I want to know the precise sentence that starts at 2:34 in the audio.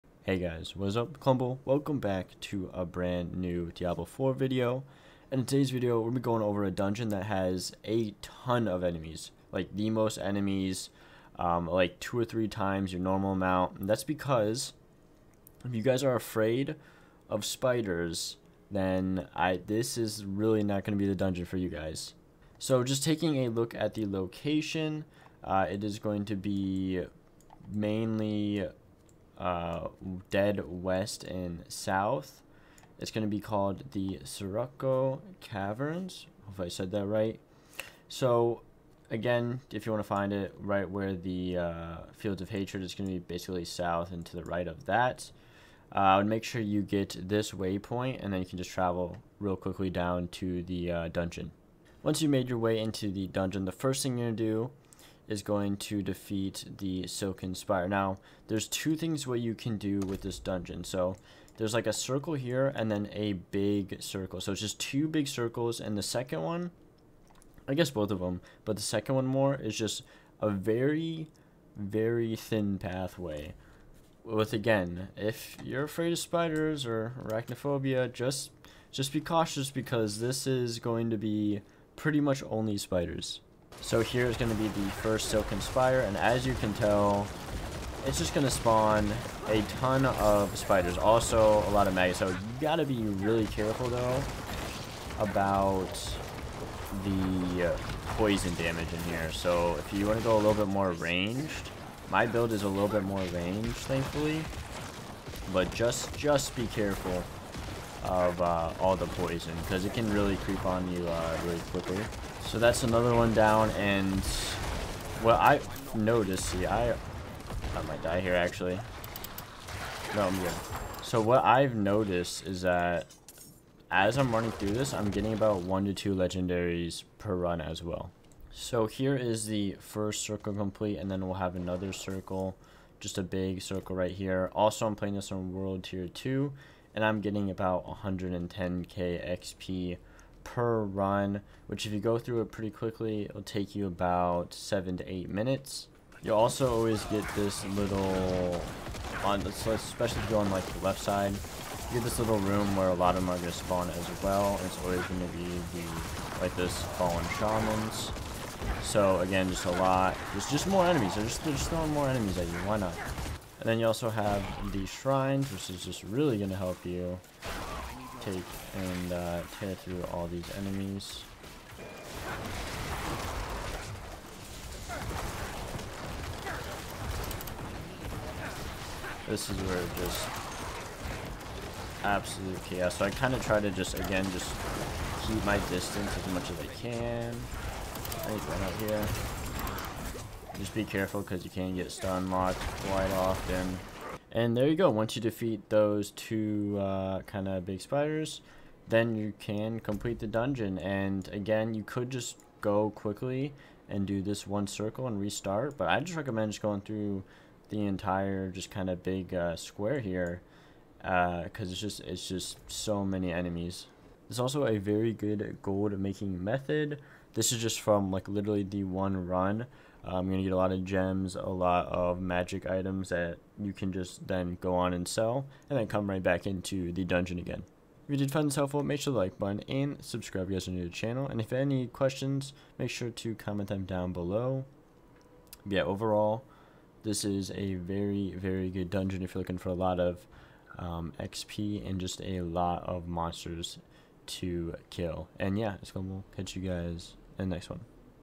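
it's always going to be the, like this fallen shamans.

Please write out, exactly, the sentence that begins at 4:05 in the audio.
And yeah, it's going to catch you guys in the next one.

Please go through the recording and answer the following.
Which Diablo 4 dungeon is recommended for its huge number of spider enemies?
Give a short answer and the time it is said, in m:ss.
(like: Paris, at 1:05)
Sirocco Caverns, at 0:34.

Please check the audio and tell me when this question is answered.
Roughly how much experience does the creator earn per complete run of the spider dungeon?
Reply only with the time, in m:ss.
2:17.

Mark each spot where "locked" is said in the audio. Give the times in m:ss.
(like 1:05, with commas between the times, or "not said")
3:12.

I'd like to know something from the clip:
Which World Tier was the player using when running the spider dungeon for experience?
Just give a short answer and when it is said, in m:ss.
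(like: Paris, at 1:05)
World Tier 2, at 2:15.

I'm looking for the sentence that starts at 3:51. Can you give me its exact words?
And if you have any questions, make sure to comment them down below.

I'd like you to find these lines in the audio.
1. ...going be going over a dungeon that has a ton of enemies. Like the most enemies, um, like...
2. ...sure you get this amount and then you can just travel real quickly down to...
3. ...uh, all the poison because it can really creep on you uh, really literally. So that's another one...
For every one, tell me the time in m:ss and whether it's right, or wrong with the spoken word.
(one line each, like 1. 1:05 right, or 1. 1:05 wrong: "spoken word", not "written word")
1. 0:06 right
2. 0:46 wrong: "waypoint", not "amount"
3. 1:48 wrong: "quickly", not "literally".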